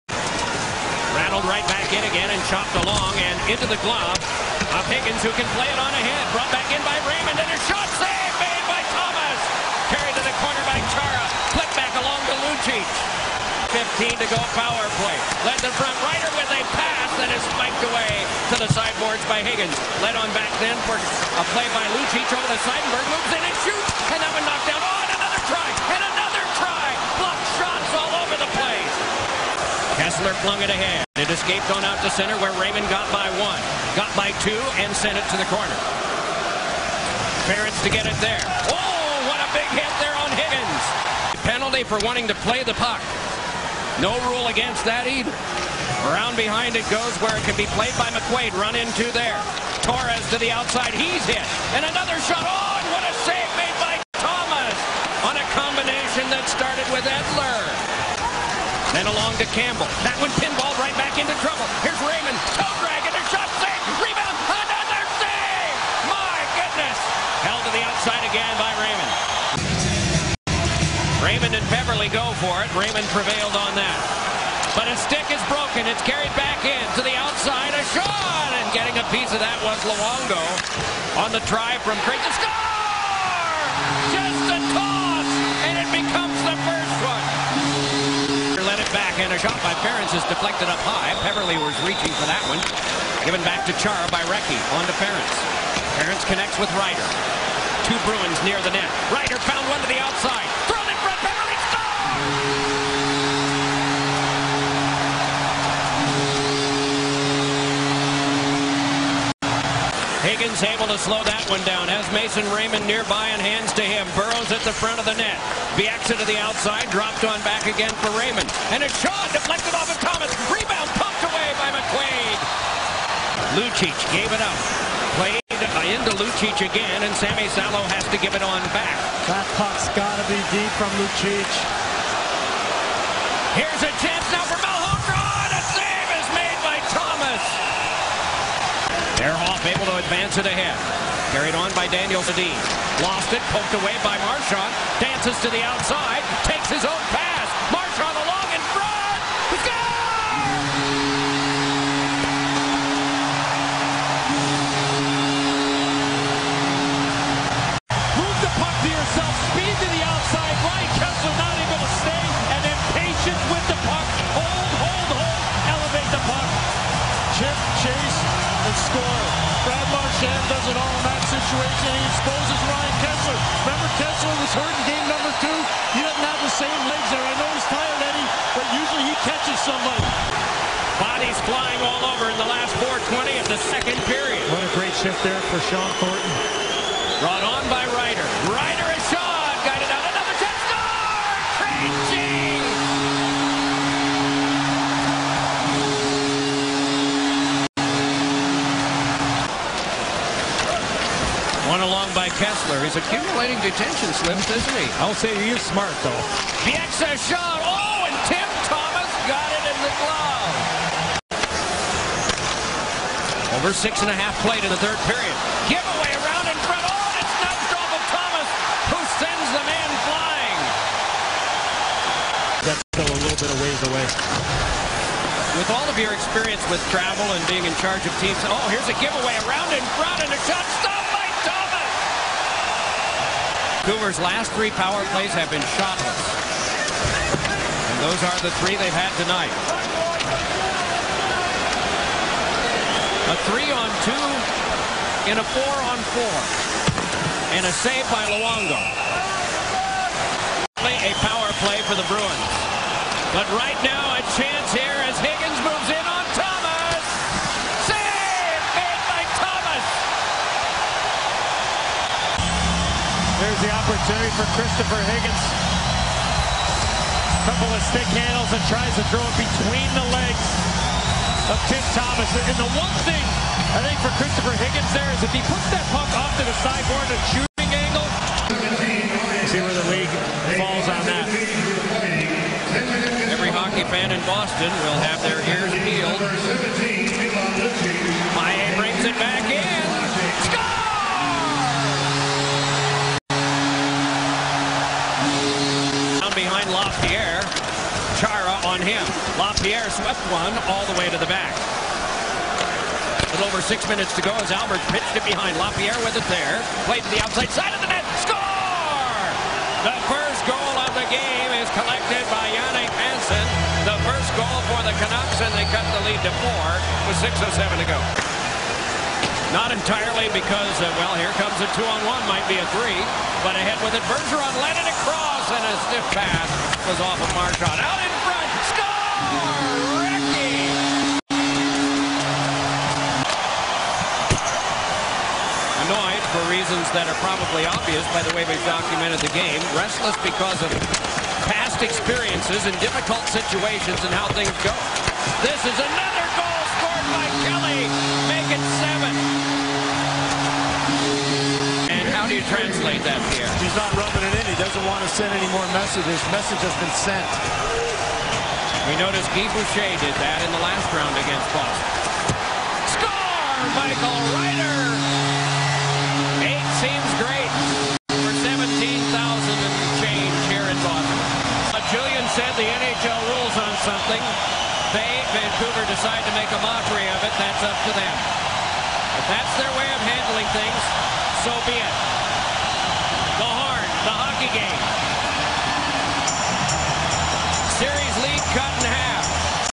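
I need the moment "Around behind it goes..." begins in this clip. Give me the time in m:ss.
0:46.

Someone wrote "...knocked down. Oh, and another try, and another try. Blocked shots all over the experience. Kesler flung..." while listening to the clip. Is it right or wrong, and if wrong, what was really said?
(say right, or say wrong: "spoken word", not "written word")
wrong: "place", not "experience".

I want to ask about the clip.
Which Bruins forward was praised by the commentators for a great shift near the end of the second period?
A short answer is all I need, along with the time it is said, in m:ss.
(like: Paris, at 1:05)
Shawn Thornton, at 3:05.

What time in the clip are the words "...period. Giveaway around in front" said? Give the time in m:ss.
3:35.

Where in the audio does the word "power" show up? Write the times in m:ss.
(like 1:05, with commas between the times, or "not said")
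0:14, 3:54, 4:11.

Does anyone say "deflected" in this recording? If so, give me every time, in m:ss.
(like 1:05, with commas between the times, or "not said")
1:30, 1:59.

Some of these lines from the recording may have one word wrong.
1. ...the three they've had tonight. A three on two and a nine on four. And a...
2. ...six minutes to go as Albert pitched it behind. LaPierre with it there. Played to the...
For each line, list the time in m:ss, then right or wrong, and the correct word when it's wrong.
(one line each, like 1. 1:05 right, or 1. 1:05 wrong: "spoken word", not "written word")
1. 3:58 wrong: "four", not "nine"
2. 5:03 right.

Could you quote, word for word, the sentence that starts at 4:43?
Every hockey fan in Boston will have their ears peeled.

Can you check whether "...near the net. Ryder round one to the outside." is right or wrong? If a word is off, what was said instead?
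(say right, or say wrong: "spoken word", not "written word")
wrong: "found", not "round".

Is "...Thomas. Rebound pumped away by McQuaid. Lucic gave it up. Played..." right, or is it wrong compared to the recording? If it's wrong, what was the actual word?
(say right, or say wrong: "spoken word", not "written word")
right.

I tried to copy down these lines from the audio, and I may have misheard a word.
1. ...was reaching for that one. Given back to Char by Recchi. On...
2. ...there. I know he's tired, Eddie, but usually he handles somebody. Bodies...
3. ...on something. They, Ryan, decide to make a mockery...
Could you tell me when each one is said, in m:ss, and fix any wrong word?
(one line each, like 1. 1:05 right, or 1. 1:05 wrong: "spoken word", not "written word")
1. 1:31 right
2. 2:57 wrong: "catches", not "handles"
3. 6:13 wrong: "Vancouver", not "Ryan".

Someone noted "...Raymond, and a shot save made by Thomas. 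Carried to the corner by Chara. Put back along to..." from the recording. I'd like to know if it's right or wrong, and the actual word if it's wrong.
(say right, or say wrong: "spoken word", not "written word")
right.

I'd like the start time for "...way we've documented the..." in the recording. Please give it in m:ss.
5:38.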